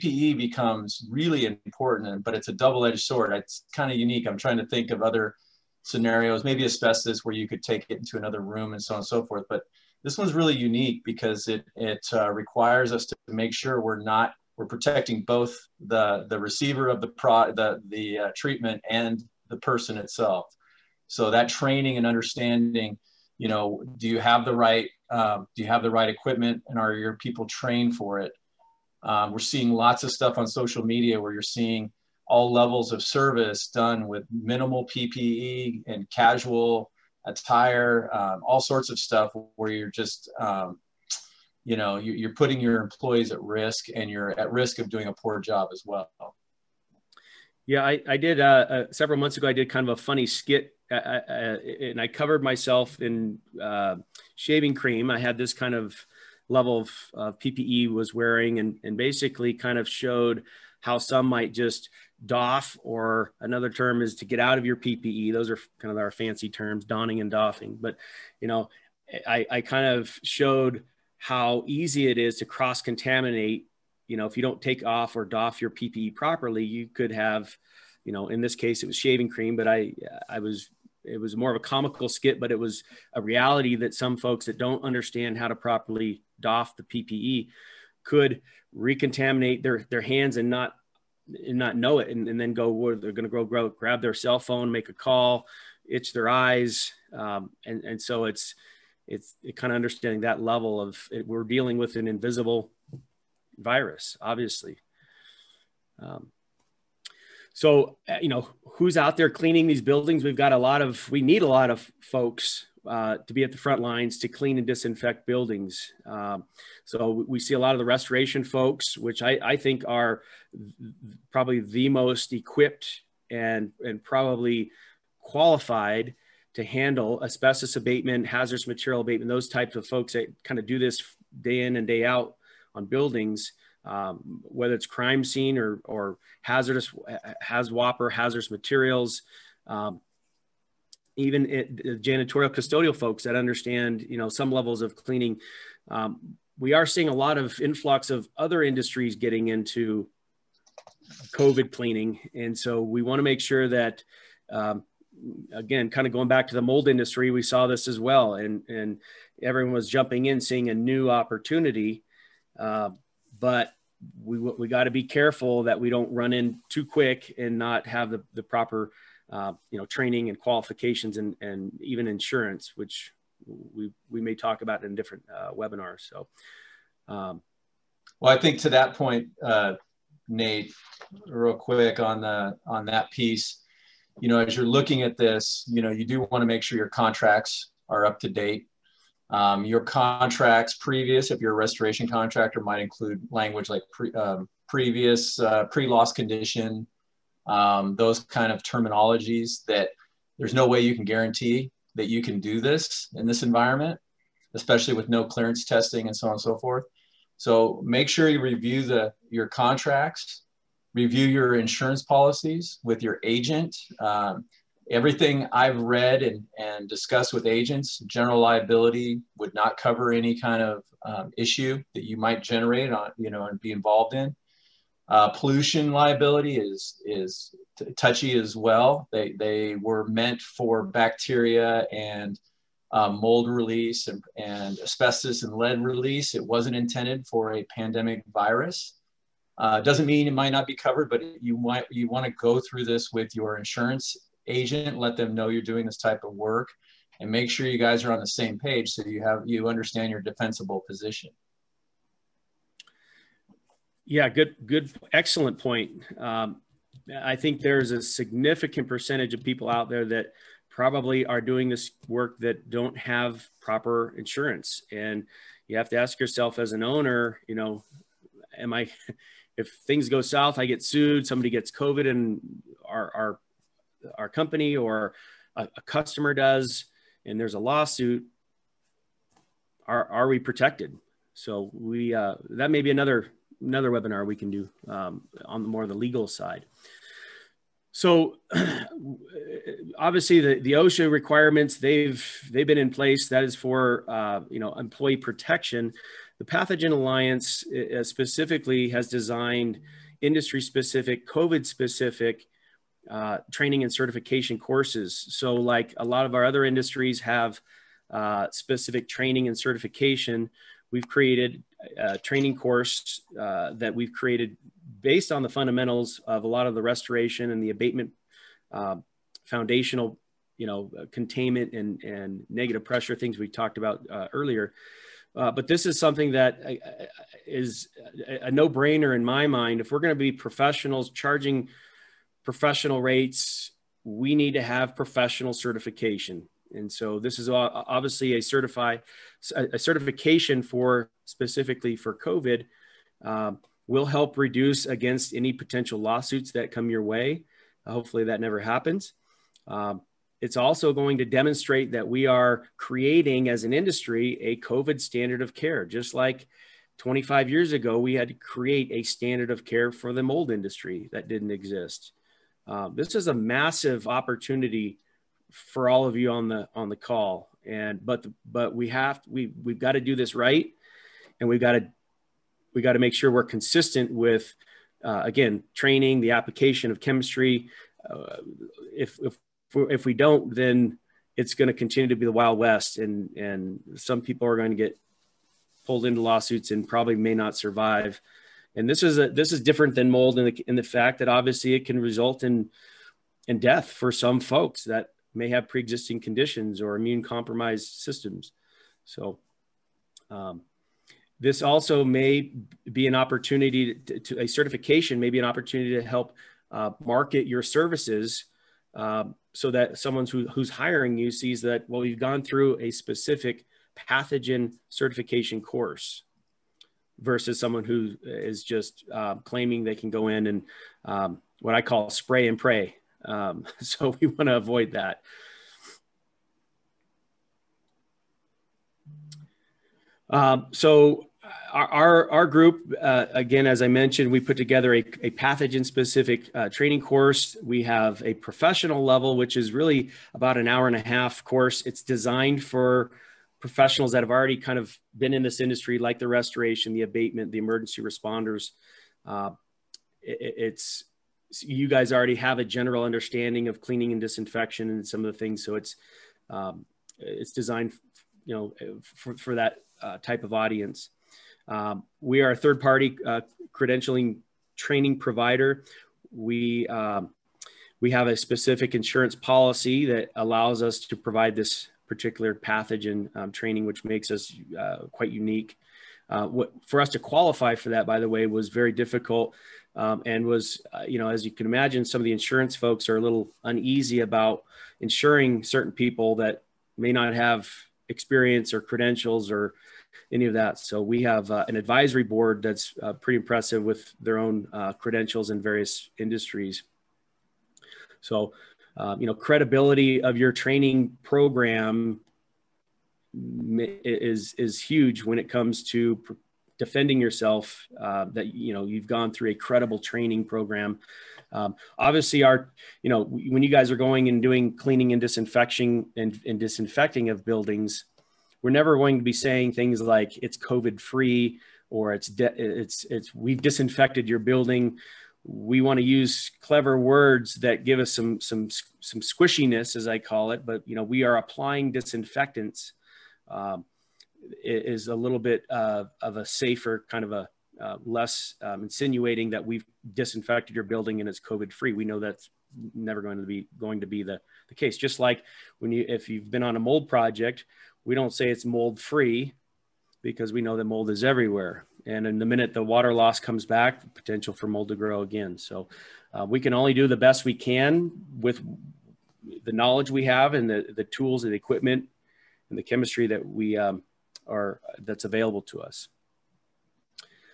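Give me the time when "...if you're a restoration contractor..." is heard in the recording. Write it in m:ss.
3:11.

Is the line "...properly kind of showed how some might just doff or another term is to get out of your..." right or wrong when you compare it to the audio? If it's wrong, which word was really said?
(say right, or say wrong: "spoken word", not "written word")
wrong: "basically", not "properly".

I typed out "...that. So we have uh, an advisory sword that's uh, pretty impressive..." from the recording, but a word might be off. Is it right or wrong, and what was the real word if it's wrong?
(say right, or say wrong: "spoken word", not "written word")
wrong: "board", not "sword".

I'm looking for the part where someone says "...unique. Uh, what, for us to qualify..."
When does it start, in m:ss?
7:55.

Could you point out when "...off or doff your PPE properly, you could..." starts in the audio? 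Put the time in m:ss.
1:14.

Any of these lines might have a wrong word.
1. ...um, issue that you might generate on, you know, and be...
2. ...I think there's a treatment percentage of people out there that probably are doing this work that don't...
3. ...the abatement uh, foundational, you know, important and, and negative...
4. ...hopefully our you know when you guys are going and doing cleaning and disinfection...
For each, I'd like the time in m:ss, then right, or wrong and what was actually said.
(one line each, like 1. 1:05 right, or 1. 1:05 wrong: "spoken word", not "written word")
1. 3:41 right
2. 4:17 wrong: "significant", not "treatment"
3. 5:17 wrong: "containment", not "important"
4. 8:31 wrong: "obviously", not "hopefully".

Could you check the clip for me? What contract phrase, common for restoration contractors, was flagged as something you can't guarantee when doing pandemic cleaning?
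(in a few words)
Pre-loss condition.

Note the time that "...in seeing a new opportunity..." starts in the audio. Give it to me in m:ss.
2:40.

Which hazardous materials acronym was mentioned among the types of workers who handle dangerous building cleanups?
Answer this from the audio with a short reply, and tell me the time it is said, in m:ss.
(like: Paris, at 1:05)
HAZWOPER, at 2:17.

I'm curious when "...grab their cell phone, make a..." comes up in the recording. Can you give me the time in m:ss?
1:33.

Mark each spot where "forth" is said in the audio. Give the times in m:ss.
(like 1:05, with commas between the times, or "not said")
0:09, 3:26.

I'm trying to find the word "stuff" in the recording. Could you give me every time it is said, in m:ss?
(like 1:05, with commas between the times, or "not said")
0:30, 0:38.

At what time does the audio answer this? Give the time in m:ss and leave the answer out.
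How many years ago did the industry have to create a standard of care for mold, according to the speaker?
5:56.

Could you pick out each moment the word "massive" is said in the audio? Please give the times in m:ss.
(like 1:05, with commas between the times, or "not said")
6:03.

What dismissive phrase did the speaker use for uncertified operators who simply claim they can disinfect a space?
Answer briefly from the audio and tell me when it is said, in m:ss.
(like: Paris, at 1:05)
Spray and pray, at 7:02.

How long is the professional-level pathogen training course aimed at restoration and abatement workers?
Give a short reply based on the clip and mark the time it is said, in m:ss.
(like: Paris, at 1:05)
About an hour and a half, at 7:20.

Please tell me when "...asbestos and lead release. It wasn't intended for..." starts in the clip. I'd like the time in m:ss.
3:54.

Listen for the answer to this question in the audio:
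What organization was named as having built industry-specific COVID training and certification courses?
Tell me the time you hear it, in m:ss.
4:56.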